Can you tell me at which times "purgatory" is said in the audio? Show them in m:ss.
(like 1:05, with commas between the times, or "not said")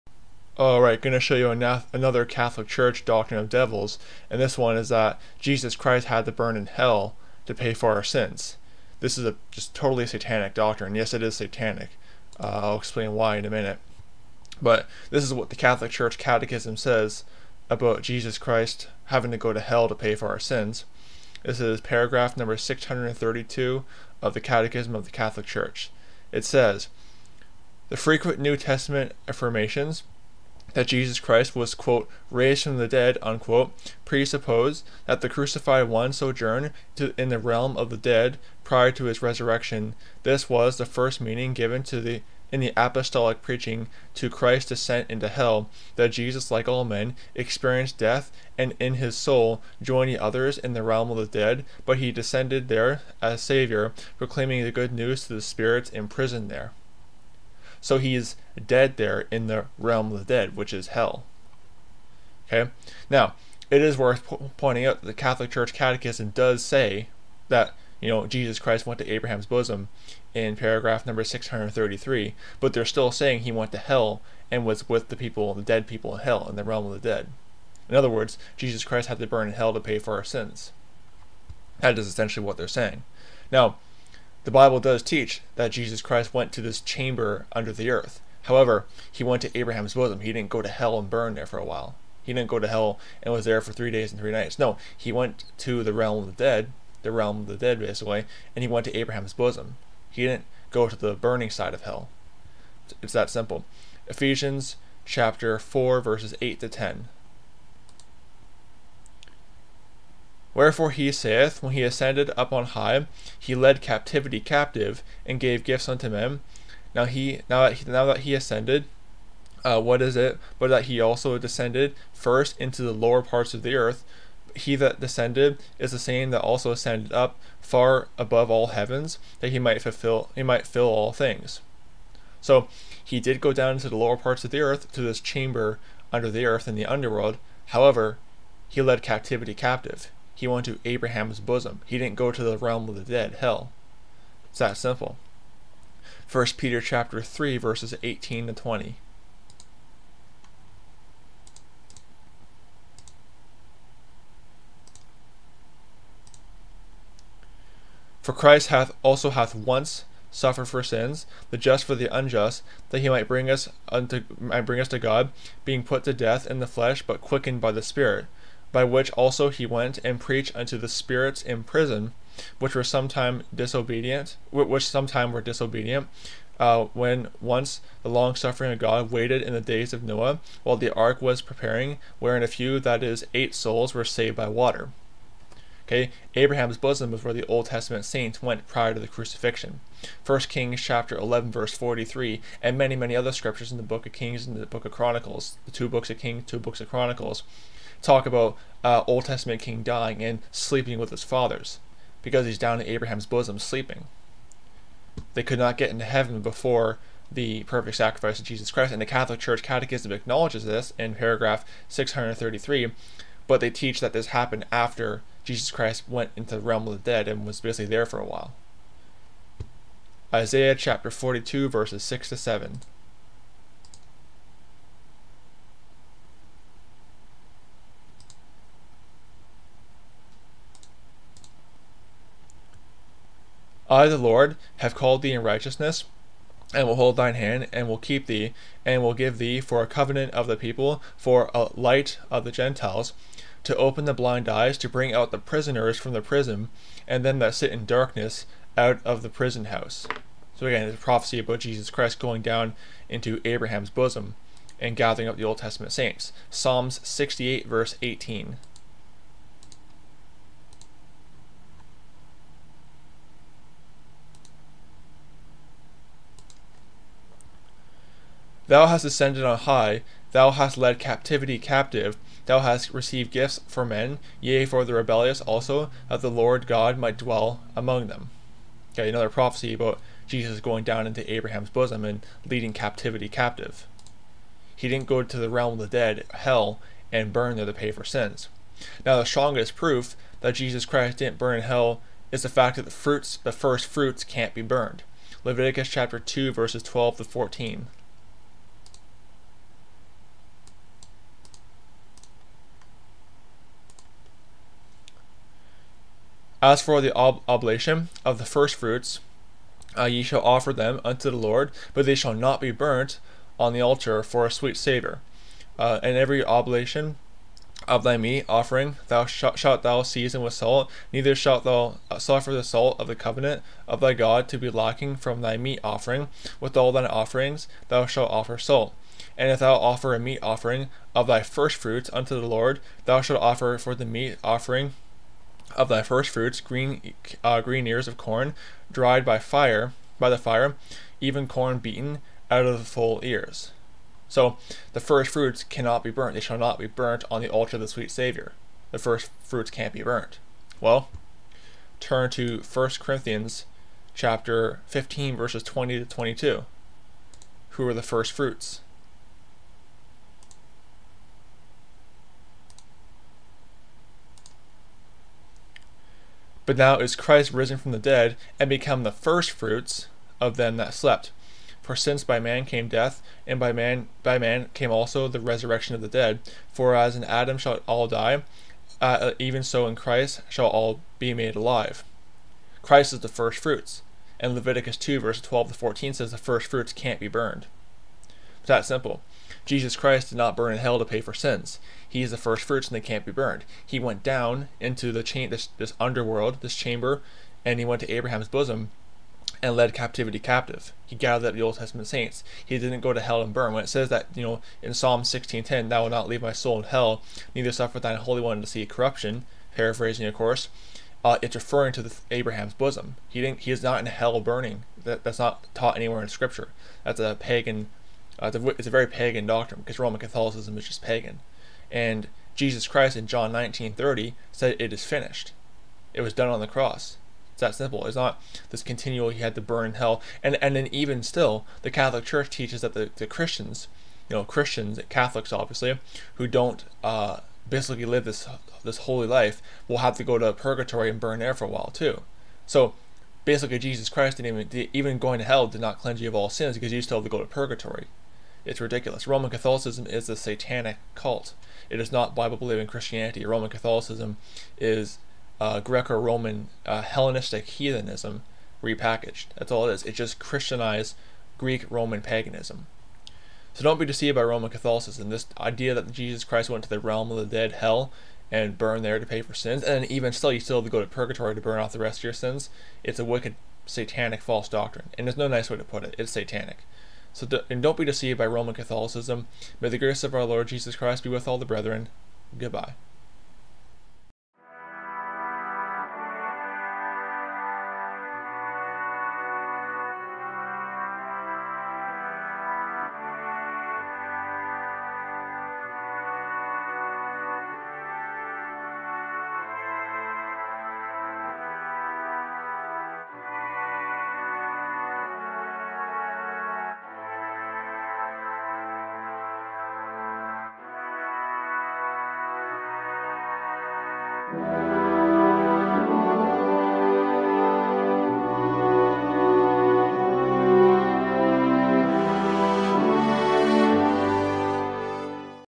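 7:20, 7:27, 7:51.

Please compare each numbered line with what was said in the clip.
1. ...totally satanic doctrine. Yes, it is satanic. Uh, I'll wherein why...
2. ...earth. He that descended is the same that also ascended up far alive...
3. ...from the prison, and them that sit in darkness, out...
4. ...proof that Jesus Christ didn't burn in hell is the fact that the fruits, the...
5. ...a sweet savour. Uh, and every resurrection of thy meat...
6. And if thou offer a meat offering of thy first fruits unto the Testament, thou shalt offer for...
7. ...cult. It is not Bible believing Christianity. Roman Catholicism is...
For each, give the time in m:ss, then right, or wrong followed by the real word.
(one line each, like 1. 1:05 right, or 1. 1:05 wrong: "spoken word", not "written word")
1. 0:09 wrong: "explain", not "wherein"
2. 2:03 wrong: "above", not "alive"
3. 4:05 right
4. 4:49 right
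5. 5:14 wrong: "oblation", not "resurrection"
6. 5:29 wrong: "Lord", not "Testament"
7. 7:31 right.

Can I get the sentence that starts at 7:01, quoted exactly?
And Jesus Christ in John 19:30 said, "It is finished." It was done on the cross.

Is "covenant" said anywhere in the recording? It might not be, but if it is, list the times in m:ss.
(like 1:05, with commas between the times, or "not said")
3:59, 5:23.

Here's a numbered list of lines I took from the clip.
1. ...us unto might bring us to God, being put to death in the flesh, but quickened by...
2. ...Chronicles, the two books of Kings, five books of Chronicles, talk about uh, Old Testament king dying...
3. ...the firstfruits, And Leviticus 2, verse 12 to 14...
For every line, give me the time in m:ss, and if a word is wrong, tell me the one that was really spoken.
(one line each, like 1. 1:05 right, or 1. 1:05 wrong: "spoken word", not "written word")
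1. 2:43 right
2. 3:14 wrong: "two", not "five"
3. 6:23 right.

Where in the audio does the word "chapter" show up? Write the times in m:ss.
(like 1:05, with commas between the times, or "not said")
1:45, 2:26, 3:10, 3:40, 4:55, 5:54.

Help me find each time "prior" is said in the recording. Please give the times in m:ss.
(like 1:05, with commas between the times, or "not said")
0:38, 3:08.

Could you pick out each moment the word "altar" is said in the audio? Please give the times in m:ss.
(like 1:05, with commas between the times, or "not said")
5:13, 5:47.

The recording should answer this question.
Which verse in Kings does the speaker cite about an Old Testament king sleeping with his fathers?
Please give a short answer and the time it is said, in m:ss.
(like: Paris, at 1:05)
1 Kings 11:43, at 3:10.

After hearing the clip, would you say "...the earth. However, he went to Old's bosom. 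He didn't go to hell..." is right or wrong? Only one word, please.
wrong.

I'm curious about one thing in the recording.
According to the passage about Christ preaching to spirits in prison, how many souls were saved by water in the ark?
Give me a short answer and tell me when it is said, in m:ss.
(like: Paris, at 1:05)
8, at 3:03.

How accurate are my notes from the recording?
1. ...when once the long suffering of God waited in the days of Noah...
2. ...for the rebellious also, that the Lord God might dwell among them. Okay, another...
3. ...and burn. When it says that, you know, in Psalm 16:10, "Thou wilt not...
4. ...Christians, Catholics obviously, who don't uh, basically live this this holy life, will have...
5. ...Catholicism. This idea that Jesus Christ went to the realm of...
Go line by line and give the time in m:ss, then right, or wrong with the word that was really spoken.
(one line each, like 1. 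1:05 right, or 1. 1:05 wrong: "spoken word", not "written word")
1. 2:56 right
2. 4:34 right
3. 6:43 right
4. 7:14 right
5. 7:44 right.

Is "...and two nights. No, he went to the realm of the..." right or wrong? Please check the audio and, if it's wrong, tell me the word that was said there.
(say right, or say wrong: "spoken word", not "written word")
wrong: "three", not "two".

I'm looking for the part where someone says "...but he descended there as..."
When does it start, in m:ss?
0:51.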